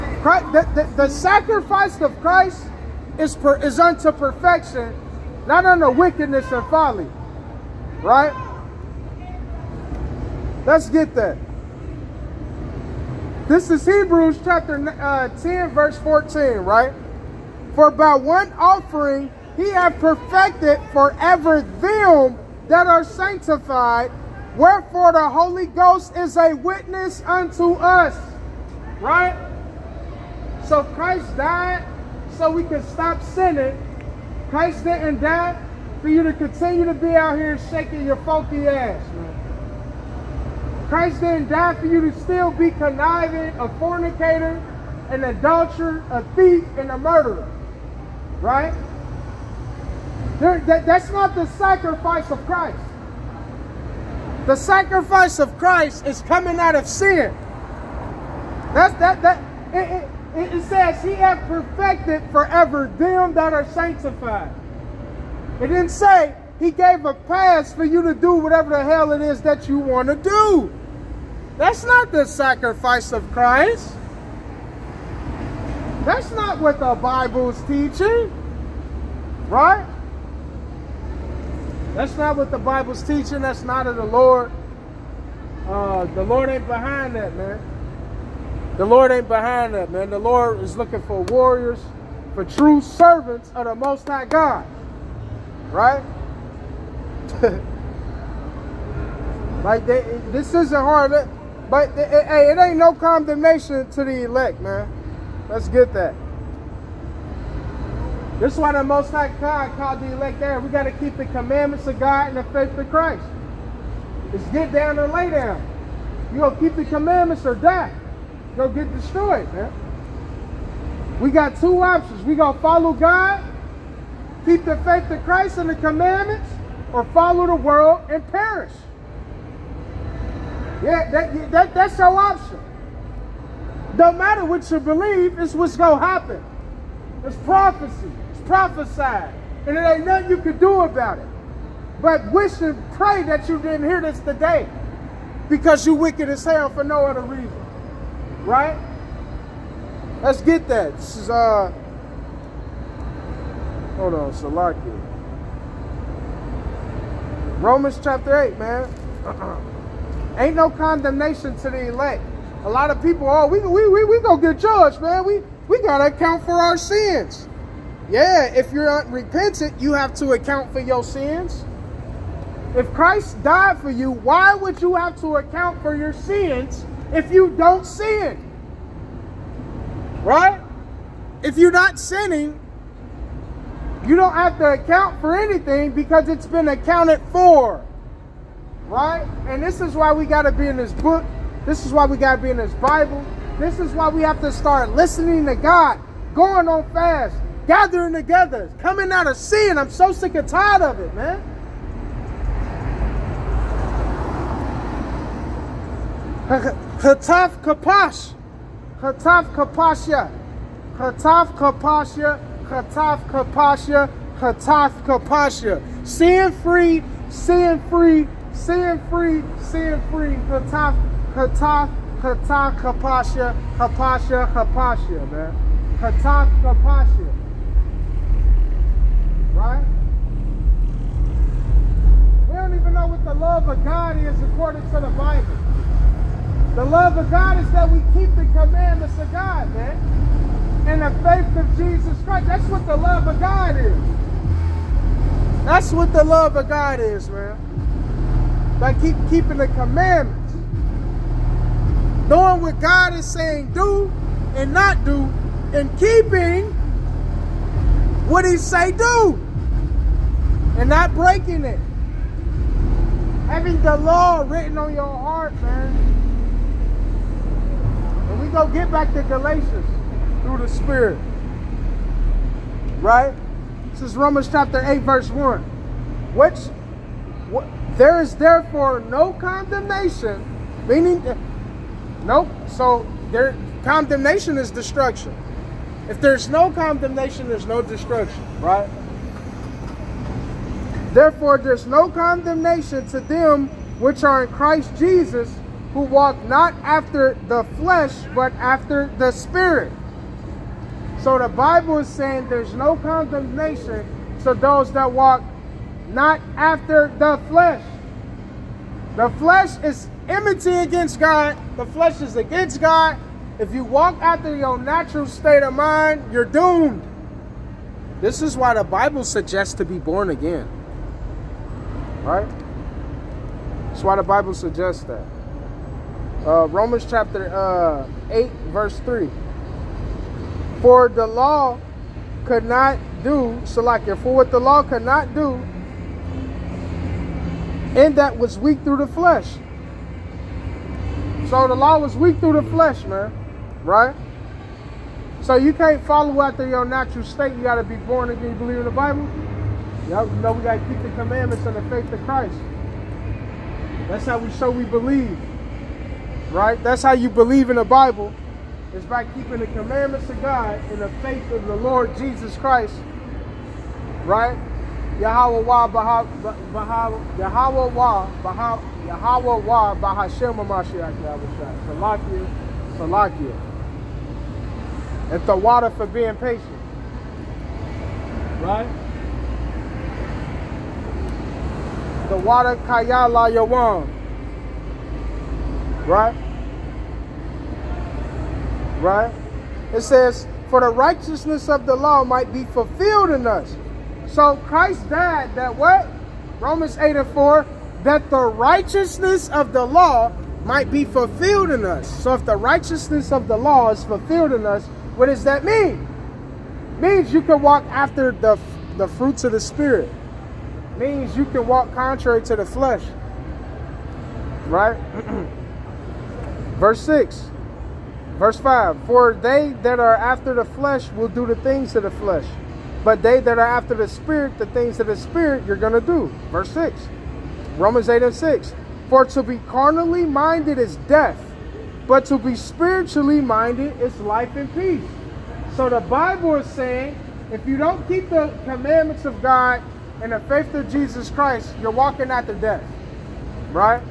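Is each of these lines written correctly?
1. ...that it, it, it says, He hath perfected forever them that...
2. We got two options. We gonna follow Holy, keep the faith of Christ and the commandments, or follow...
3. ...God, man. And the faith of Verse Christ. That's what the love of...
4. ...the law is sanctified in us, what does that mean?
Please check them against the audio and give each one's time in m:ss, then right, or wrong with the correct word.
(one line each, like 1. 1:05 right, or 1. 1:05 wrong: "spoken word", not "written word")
1. 0:59 right
2. 2:01 wrong: "God", not "Holy"
3. 3:59 wrong: "Jesus", not "Verse"
4. 6:43 wrong: "fulfilled", not "sanctified".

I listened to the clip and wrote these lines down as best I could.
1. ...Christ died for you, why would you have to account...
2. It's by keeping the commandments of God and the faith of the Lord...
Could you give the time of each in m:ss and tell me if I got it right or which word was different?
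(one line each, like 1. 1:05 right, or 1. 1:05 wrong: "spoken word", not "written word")
1. 2:52 right
2. 5:58 right.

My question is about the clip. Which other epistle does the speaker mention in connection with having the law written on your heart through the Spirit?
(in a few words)
Galatians.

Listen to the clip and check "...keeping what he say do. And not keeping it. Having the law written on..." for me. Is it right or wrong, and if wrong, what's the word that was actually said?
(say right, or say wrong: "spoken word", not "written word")
wrong: "breaking", not "keeping".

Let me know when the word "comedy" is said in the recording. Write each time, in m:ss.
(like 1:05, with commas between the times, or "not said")
not said.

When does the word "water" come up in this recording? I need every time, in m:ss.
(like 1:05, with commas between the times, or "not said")
6:15, 6:22.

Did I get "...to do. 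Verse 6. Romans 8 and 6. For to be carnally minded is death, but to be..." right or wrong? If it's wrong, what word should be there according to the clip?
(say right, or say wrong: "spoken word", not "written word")
right.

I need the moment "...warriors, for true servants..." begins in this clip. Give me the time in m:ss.
1:31.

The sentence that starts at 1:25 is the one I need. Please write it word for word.
Uh, the Lord ain't behind that, man.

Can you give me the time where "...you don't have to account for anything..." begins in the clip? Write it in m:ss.
3:04.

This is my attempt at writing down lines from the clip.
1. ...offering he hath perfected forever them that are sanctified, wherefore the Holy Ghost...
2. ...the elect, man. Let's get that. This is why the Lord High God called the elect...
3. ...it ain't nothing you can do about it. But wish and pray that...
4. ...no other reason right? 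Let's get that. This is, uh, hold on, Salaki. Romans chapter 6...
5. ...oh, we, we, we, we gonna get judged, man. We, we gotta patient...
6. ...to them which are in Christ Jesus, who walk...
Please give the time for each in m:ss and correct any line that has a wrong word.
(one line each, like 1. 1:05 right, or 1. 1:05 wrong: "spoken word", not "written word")
1. 0:18 right
2. 1:44 wrong: "Most", not "Lord"
3. 2:19 right
4. 2:26 wrong: "8", not "6"
5. 2:43 wrong: "account", not "patient"
6. 4:53 right.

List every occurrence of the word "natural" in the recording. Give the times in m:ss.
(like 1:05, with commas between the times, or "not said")
5:14, 5:46.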